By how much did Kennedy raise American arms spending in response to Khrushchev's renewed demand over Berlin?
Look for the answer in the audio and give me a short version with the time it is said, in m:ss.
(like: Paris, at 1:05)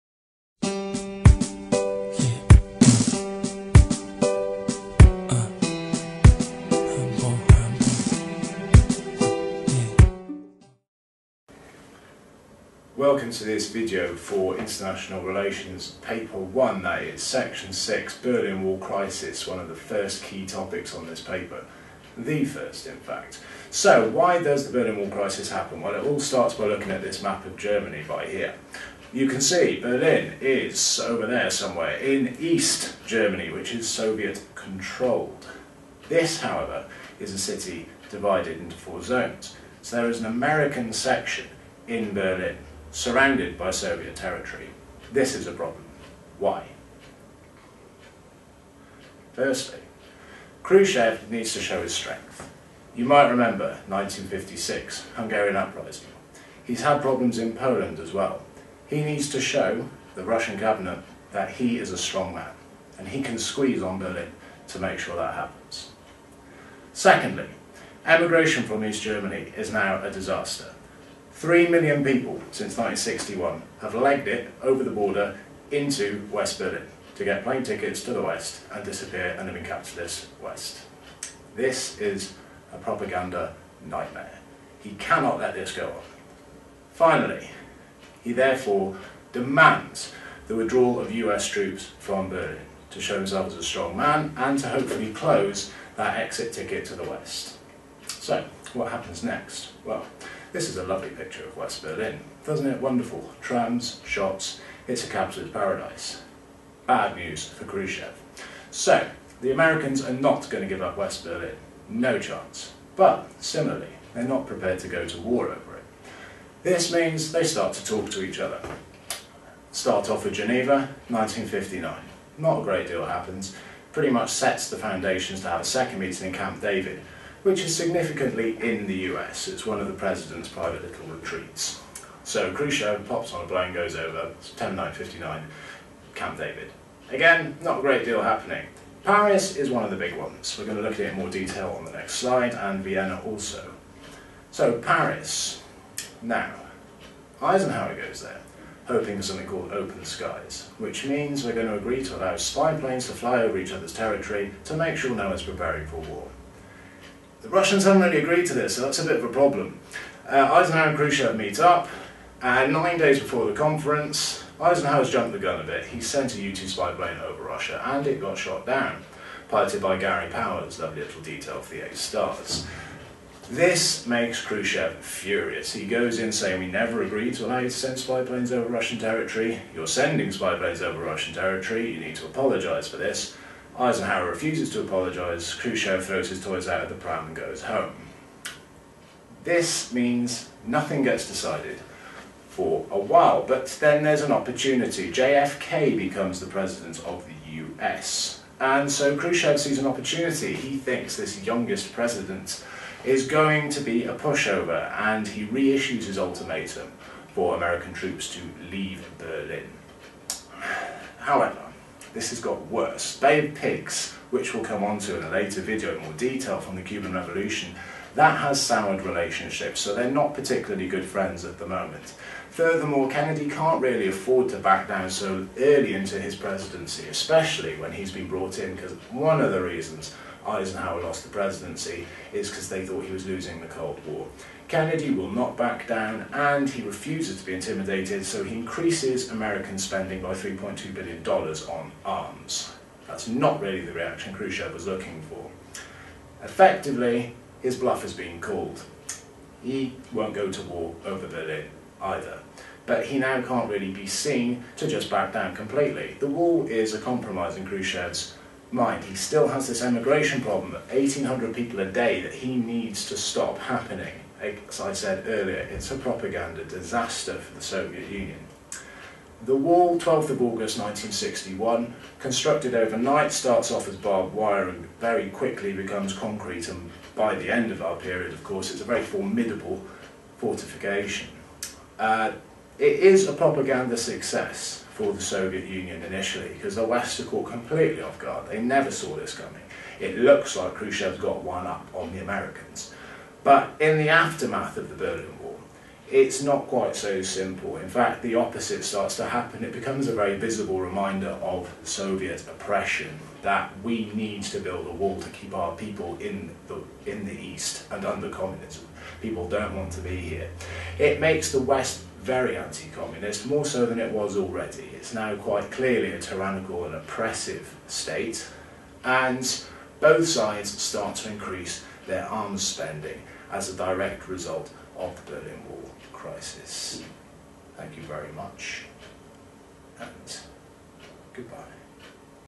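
$3.2 billion, at 4:00.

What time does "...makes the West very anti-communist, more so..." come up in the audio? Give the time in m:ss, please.
5:11.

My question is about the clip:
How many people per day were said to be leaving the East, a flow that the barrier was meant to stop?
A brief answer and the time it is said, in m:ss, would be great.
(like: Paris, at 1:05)
1,800, at 4:20.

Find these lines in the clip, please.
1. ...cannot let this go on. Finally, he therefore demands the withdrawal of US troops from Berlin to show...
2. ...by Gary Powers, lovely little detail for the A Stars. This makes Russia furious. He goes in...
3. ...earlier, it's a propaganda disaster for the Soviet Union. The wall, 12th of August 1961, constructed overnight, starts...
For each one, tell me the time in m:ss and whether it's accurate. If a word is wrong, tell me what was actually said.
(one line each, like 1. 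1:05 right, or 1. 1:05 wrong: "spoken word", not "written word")
1. 1:24 right
2. 2:49 wrong: "Khrushchev", not "Russia"
3. 4:25 right.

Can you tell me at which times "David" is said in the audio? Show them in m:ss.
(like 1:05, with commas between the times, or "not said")
2:06, 2:16.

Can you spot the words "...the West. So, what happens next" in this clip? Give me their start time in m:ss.
1:36.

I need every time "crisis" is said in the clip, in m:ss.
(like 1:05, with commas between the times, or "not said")
0:18, 0:25, 5:26.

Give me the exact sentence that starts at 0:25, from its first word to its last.
Well, it all starts by looking at this map of Germany by here.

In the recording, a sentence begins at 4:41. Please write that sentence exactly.
Uh, it is a propaganda success for the Soviet Union initially because the West are caught completely off guard.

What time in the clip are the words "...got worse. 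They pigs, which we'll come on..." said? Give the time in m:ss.
3:32.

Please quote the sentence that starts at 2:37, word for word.
The Russians haven't really agreed to this, so that's a bit of a problem.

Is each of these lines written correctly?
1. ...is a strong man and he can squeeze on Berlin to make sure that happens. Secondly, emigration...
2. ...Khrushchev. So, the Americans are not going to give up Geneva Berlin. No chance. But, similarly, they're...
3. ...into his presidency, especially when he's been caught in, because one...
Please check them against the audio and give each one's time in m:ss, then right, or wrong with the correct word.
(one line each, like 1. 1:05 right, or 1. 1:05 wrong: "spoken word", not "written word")
1. 1:01 right
2. 1:47 wrong: "West", not "Geneva"
3. 3:45 wrong: "brought", not "caught".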